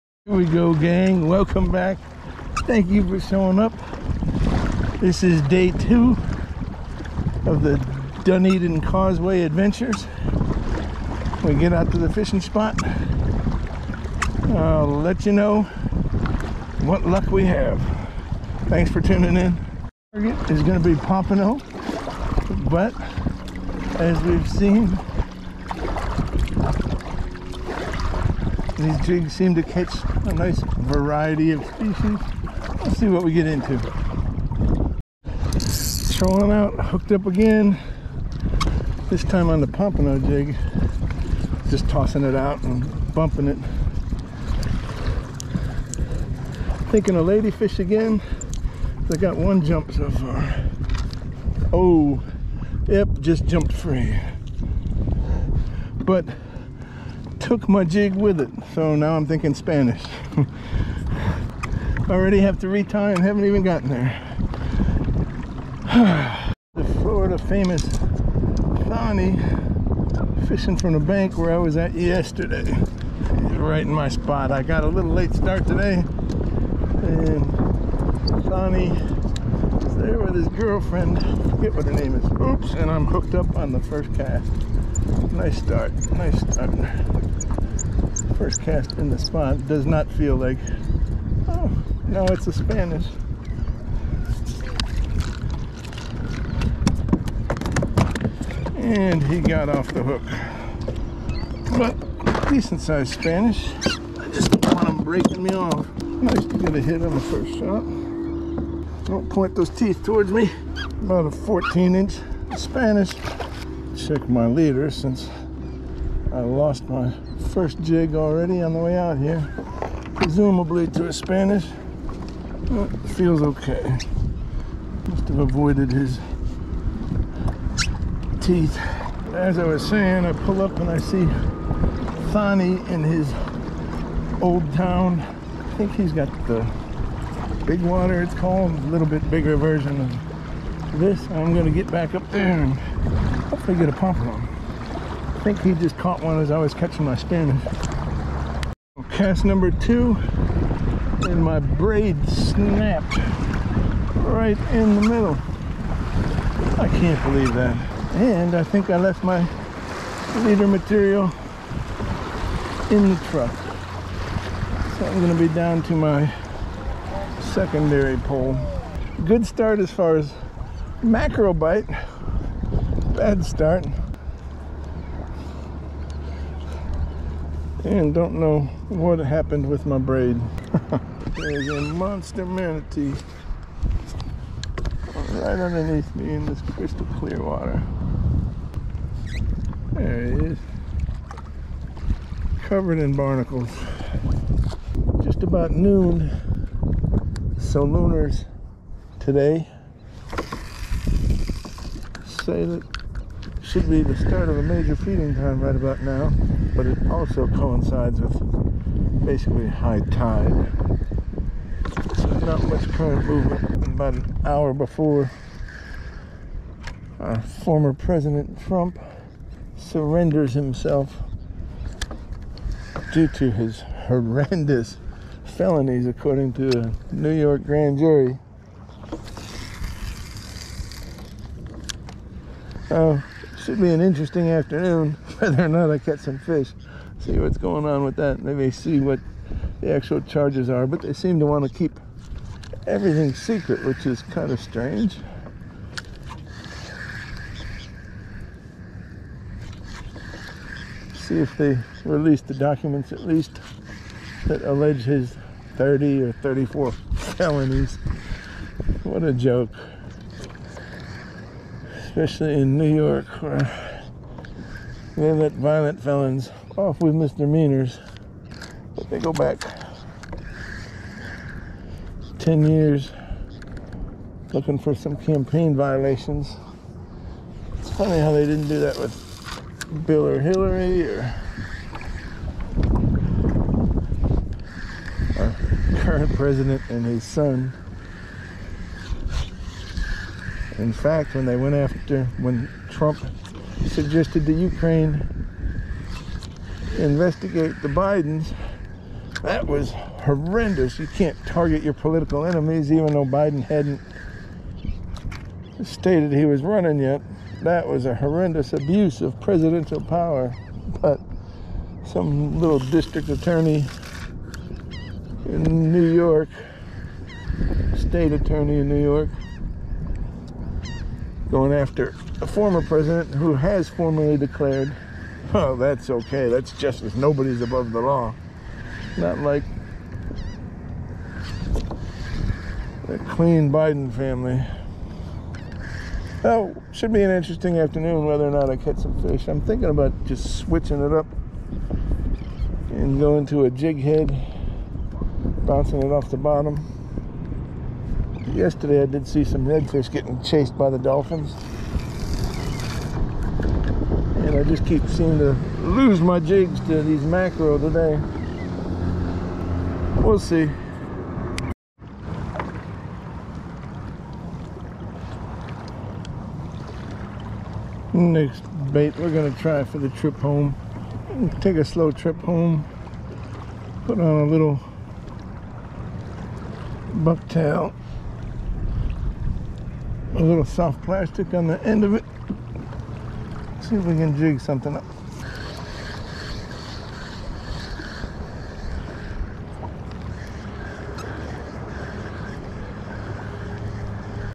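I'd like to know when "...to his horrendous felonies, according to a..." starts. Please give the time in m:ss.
3:43.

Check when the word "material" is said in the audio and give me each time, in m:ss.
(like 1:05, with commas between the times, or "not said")
2:40.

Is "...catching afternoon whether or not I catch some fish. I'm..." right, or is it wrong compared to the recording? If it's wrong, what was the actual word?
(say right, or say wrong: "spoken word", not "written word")
wrong: "interesting", not "catching".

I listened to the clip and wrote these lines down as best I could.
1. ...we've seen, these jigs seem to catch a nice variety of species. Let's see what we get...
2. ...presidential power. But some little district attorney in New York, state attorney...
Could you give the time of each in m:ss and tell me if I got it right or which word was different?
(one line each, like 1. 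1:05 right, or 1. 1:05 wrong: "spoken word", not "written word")
1. 0:24 right
2. 5:09 right.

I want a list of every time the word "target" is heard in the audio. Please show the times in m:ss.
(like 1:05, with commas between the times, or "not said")
0:20, 5:01.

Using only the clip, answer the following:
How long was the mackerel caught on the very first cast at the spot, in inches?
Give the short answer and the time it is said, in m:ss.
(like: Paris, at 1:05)
14, at 1:51.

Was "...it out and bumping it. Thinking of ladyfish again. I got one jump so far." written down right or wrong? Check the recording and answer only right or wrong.
right.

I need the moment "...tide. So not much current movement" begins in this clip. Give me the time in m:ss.
3:30.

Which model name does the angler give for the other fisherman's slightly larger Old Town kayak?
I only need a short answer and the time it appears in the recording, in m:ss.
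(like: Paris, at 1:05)
big water, at 2:17.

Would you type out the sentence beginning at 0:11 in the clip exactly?
We get out to the fishing spot.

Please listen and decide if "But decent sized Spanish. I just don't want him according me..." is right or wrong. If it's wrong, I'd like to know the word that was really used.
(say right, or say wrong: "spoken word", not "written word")
wrong: "breaking", not "according".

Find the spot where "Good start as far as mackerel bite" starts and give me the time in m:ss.
2:49.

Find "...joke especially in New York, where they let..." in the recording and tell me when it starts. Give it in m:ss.
4:19.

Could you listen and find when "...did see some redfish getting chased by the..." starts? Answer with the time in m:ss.
5:49.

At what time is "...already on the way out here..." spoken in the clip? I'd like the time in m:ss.
1:58.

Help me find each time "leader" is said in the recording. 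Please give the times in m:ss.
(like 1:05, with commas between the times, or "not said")
1:54, 2:40.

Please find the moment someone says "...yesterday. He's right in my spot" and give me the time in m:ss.
1:11.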